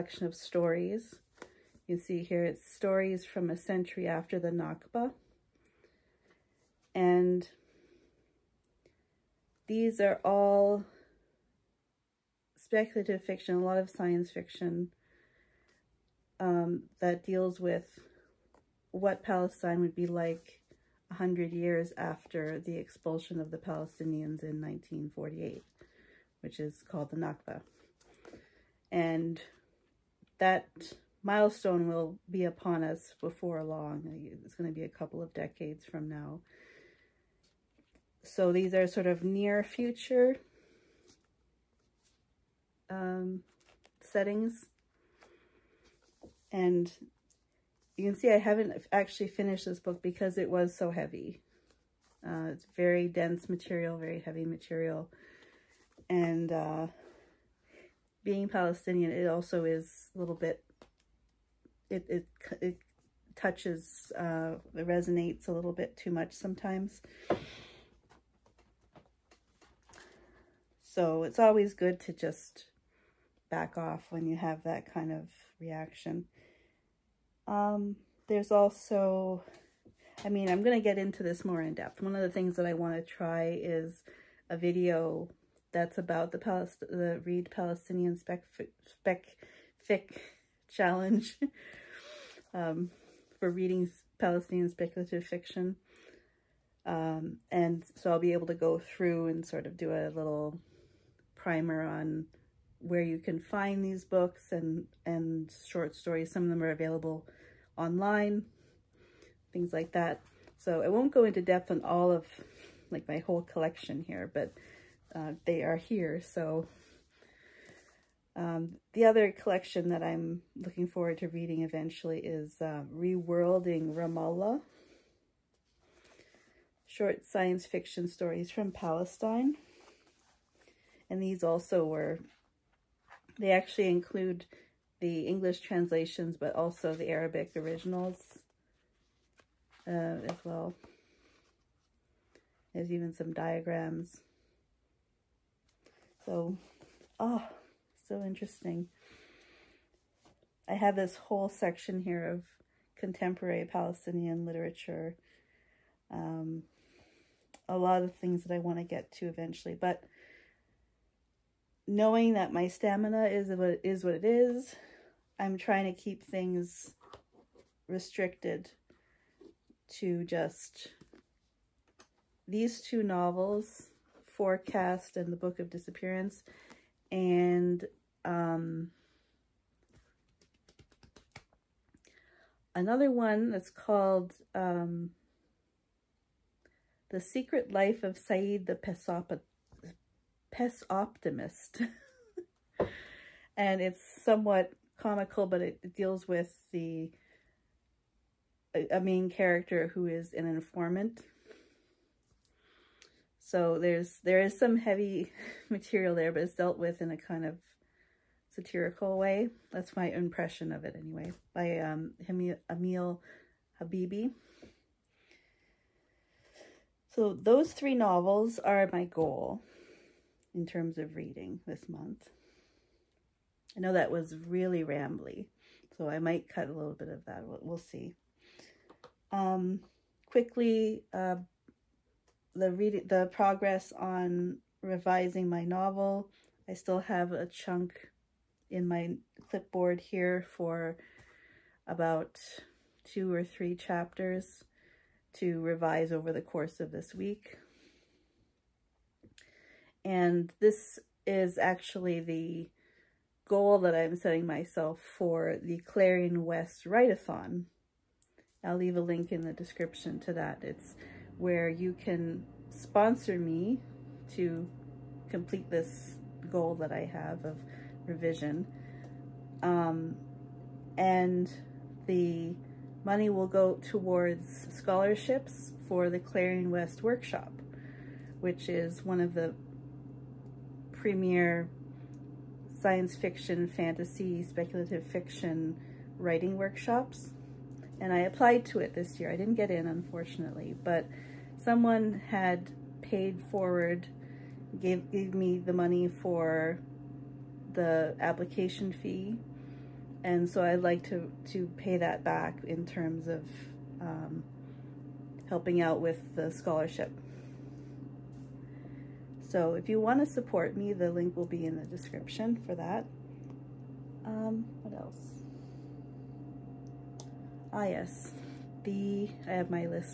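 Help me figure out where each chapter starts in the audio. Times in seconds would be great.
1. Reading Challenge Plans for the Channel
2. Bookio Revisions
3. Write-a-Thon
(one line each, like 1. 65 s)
1. 75 s
2. 231 s
3. 257 s.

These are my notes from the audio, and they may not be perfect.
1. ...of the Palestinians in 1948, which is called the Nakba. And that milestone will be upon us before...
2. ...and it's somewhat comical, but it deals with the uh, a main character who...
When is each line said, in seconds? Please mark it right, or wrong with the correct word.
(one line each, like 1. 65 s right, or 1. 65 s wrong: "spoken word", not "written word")
1. 23 s right
2. 193 s right.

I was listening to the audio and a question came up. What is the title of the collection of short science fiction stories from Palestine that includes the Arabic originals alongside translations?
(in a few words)
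Reworlding Ramallah.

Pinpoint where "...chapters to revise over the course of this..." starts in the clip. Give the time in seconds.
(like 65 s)
243 s.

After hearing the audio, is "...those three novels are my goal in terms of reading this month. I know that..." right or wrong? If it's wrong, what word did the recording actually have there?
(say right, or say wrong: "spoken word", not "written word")
right.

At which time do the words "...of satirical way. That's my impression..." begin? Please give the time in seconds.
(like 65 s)
207 s.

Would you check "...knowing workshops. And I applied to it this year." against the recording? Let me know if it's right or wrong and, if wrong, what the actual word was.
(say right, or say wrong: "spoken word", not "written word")
wrong: "writing", not "knowing".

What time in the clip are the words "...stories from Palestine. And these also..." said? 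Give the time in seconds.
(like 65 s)
128 s.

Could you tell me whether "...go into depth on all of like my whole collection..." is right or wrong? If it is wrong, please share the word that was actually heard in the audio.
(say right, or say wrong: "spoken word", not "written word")
right.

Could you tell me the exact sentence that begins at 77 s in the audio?
Um, there's also, I mean, I'm going to get into this more in depth.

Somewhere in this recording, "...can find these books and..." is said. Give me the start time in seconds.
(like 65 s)
103 s.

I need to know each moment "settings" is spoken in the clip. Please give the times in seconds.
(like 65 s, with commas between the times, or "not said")
44 s, 254 s.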